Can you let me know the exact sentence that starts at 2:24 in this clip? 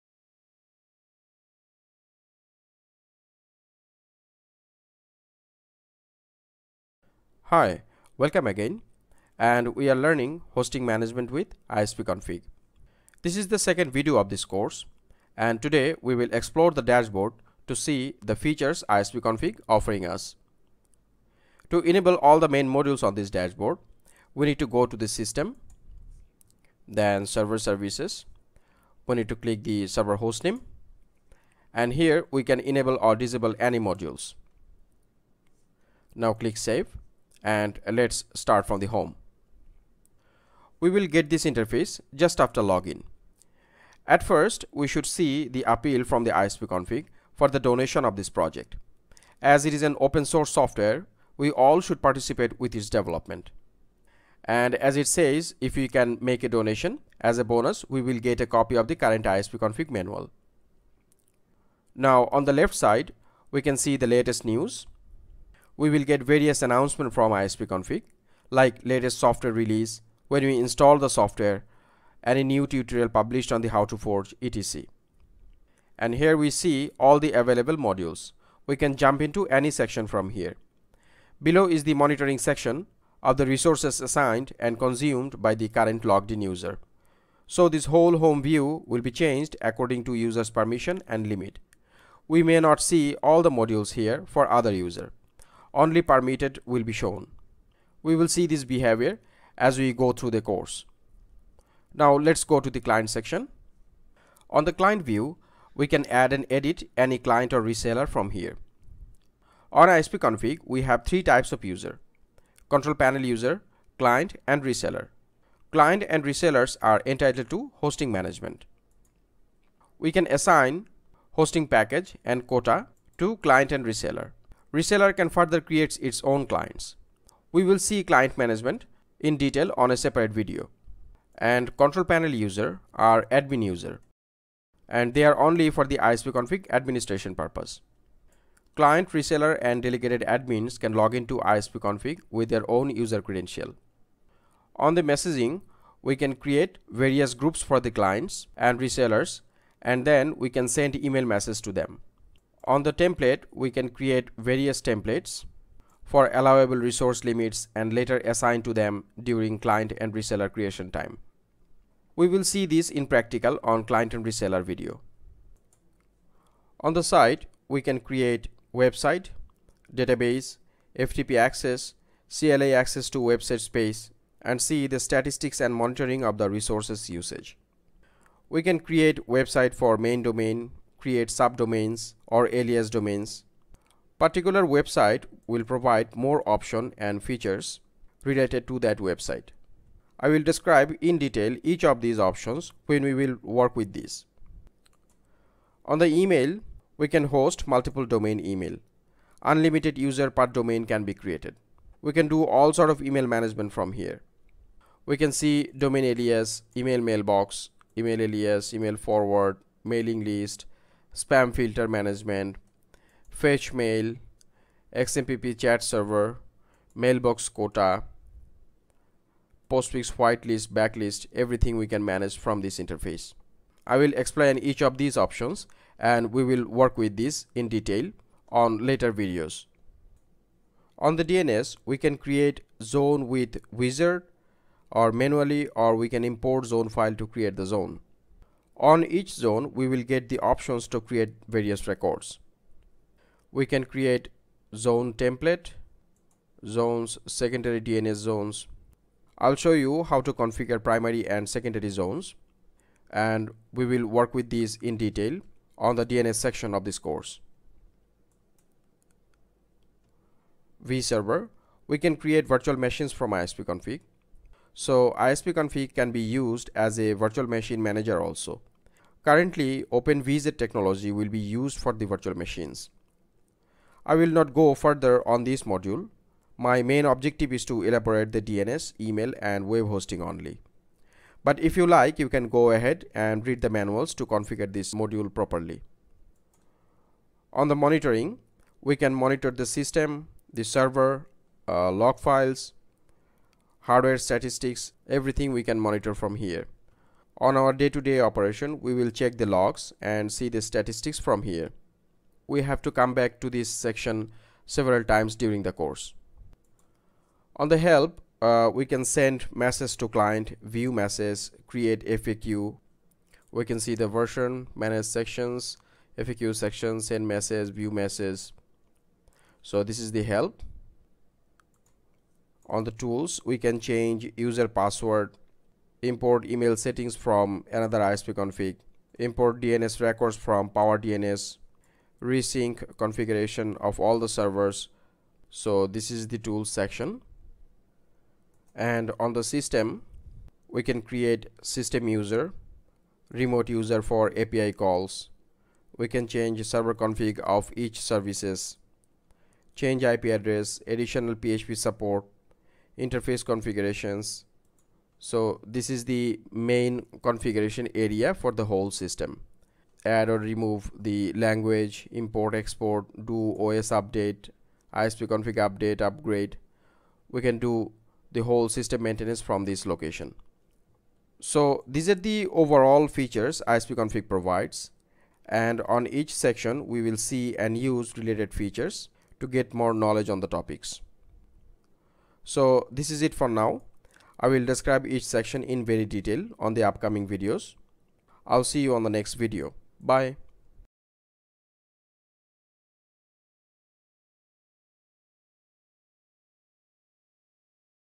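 On the messaging, we can create various groups for the clients and resellers and then we can send email message to them.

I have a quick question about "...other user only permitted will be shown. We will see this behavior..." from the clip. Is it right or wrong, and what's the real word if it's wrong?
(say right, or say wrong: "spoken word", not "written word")
right.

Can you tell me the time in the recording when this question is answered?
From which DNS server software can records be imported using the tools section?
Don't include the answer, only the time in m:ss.
5:30.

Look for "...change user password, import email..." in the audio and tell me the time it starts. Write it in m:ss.
5:23.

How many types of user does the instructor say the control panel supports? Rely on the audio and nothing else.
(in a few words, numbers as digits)
3.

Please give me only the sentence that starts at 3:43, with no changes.
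I will explain each of these options and we will work with this in detail on later videos.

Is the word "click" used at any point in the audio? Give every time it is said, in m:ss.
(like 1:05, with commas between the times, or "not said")
0:29, 0:36.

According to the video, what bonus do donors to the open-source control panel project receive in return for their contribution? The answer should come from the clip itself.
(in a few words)
Copy of the current ISPConfig manual.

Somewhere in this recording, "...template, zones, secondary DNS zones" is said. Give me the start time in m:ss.
4:05.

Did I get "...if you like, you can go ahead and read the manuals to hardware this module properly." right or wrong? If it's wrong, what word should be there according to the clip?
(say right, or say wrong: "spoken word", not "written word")
wrong: "configure", not "hardware".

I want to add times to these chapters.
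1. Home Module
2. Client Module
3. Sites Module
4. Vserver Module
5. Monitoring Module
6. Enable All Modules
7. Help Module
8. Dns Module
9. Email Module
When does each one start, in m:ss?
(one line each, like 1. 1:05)
1. 0:40
2. 1:42
3. 2:45
4. 4:21
5. 4:47
6. 0:20
7. 5:07
8. 3:49
9. 3:15.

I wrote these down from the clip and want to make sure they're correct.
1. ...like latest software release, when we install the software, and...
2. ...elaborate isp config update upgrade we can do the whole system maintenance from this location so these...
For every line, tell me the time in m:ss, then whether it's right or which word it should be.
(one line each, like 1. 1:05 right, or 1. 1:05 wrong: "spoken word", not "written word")
1. 1:08 right
2. 6:03 wrong: "update", not "elaborate".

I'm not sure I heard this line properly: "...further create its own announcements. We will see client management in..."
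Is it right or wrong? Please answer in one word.
wrong.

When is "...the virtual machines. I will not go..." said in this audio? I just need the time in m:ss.
4:31.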